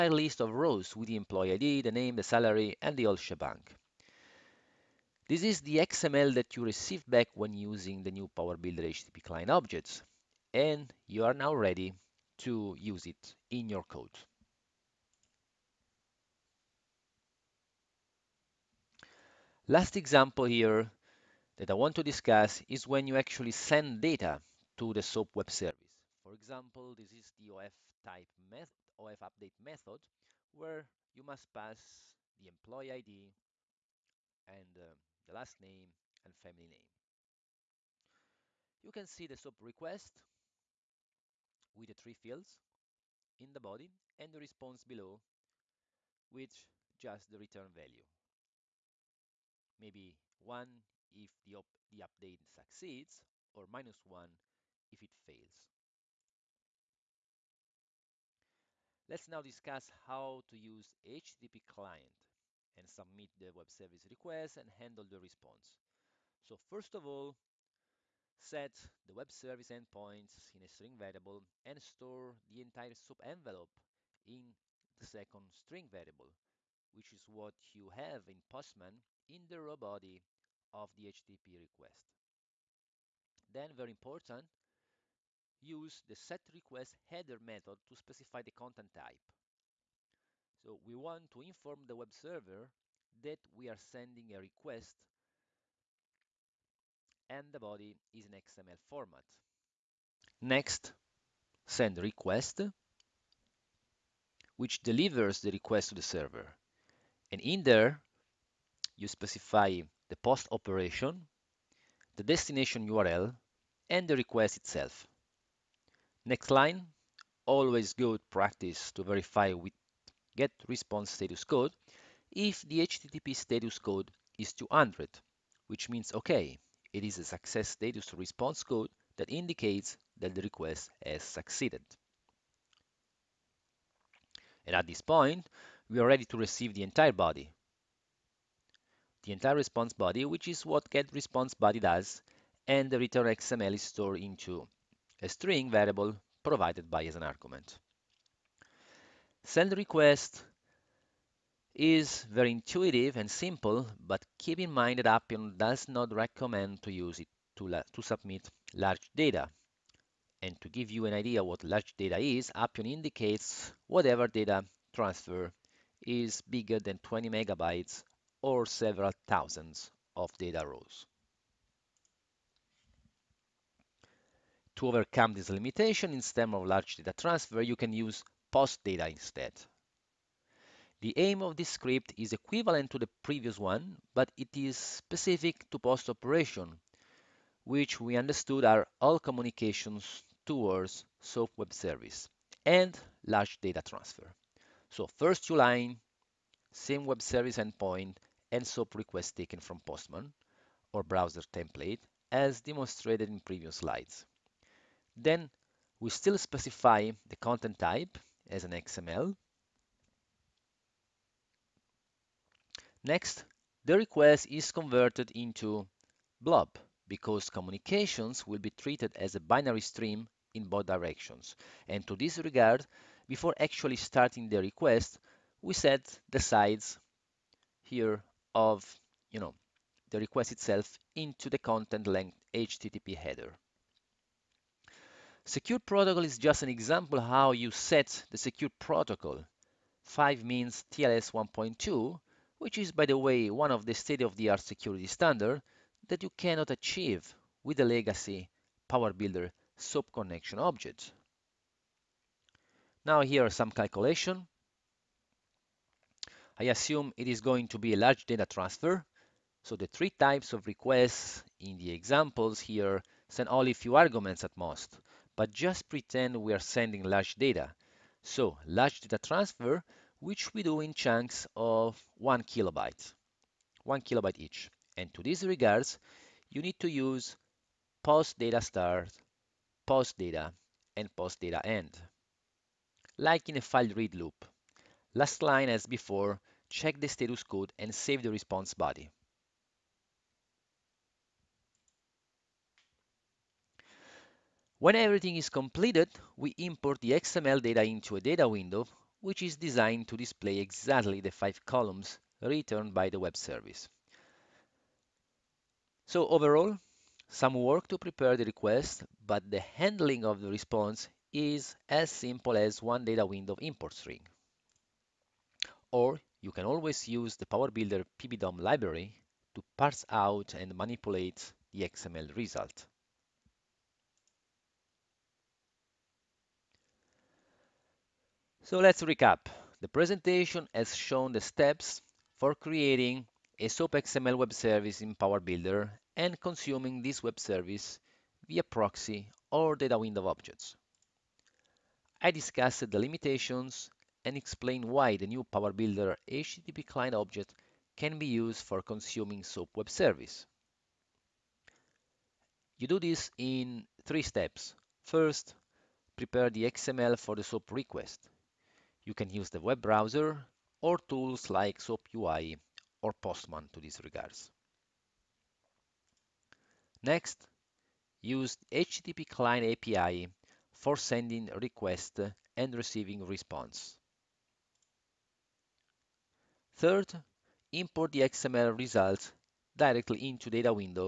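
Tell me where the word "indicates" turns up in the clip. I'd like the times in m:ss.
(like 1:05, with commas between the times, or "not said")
2:09, 2:42.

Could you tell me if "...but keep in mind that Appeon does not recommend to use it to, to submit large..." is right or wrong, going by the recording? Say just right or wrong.
right.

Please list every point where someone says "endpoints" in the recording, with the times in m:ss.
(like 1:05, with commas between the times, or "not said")
1:09, 3:17.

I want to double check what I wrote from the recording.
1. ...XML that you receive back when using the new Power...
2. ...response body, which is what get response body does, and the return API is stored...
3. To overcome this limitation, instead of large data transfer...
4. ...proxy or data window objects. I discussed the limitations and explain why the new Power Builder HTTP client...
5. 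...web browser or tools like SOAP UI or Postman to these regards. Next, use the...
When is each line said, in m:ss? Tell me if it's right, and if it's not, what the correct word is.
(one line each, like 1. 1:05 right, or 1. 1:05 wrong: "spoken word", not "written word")
1. 0:05 right
2. 2:19 wrong: "XML", not "API"
3. 2:54 right
4. 5:38 right
5. 5:59 right.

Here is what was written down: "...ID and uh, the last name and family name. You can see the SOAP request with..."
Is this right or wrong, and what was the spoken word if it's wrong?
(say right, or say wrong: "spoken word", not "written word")
right.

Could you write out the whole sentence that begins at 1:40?
Next, send request, which delivers the request to the server.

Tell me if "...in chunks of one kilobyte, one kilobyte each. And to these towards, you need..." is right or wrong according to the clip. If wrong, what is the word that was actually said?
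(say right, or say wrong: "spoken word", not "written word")
wrong: "regards", not "towards".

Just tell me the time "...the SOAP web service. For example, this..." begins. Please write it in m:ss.
0:24.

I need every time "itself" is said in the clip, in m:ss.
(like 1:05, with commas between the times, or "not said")
1:54, 3:50.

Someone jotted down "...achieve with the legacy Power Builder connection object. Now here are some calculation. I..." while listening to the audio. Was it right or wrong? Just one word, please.
right.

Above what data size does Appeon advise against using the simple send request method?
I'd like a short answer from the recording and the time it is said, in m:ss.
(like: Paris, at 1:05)
20 megabytes, at 2:47.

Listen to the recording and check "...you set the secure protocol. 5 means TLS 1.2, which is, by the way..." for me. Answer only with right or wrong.
right.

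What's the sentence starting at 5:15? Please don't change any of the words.
Or you can always use the Power Builder PBDOM library to parse out and manipulate the XML result.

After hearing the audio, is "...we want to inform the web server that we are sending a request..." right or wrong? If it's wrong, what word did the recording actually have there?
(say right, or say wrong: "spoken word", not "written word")
right.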